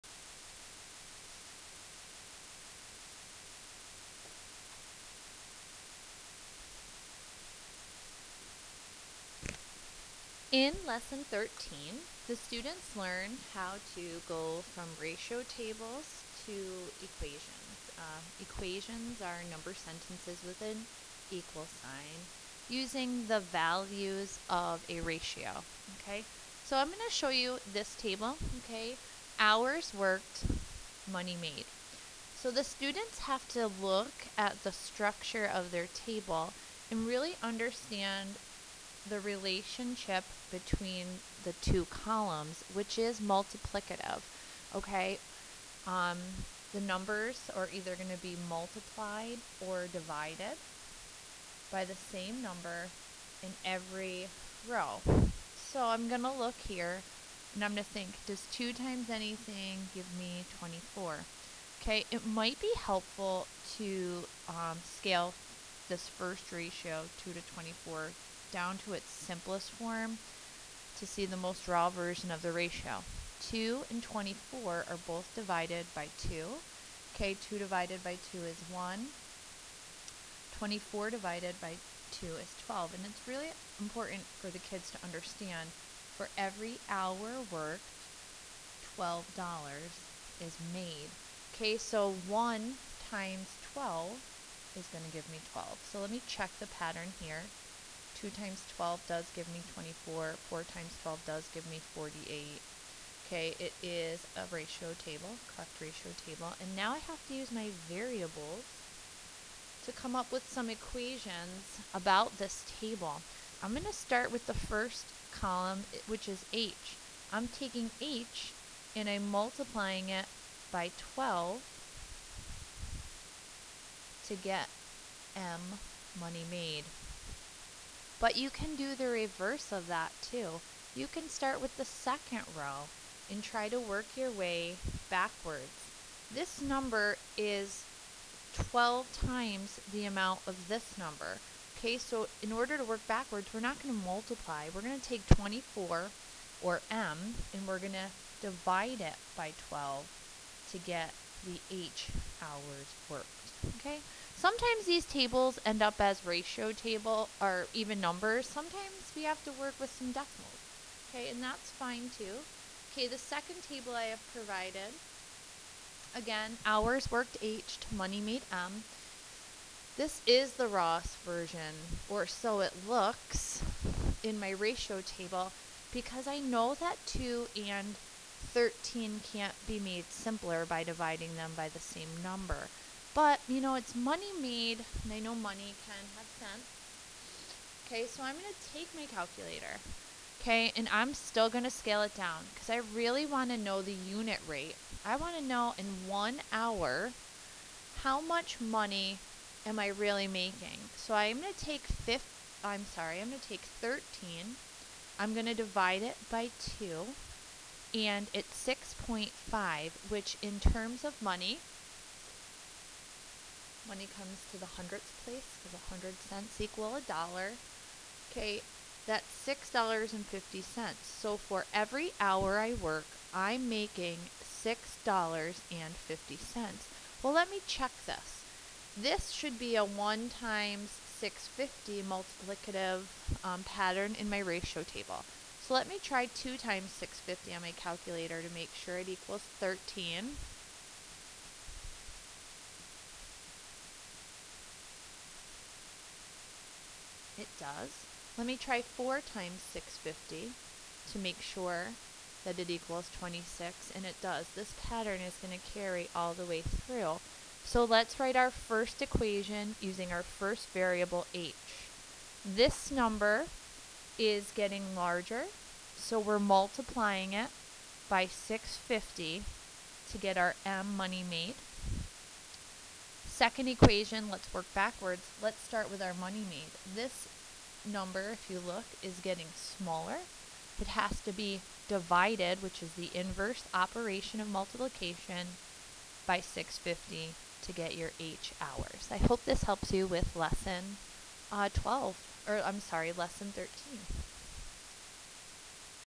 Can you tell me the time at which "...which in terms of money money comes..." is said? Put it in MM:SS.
03:30.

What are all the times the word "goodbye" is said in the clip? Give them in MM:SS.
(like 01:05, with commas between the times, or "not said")
not said.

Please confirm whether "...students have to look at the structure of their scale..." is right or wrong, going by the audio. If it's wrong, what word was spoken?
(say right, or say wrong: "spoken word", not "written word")
wrong: "table", not "scale".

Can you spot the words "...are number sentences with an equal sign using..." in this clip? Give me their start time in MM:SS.
00:19.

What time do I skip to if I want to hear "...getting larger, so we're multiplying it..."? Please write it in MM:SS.
04:24.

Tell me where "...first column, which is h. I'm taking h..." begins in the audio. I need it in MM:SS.
01:54.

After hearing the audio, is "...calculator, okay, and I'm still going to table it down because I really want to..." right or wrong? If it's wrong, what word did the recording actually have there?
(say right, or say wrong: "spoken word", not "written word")
wrong: "scale", not "table".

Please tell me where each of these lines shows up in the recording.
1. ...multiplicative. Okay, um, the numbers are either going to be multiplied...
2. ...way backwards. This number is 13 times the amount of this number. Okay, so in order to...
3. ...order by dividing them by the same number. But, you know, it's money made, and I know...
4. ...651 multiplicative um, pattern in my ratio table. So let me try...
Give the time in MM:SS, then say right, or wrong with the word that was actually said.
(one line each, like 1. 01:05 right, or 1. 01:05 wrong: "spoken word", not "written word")
1. 00:43 right
2. 02:14 wrong: "12", not "13"
3. 03:00 wrong: "simpler", not "order"
4. 03:51 wrong: "650", not "651".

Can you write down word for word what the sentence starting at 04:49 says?
I hope this helps you with lesson uh, 12, or I'm sorry, lesson 13.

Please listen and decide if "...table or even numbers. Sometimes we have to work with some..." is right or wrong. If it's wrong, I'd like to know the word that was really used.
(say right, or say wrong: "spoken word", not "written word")
right.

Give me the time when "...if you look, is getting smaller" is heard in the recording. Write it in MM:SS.
04:38.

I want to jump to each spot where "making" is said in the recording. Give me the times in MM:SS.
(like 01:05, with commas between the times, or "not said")
03:20, 03:43.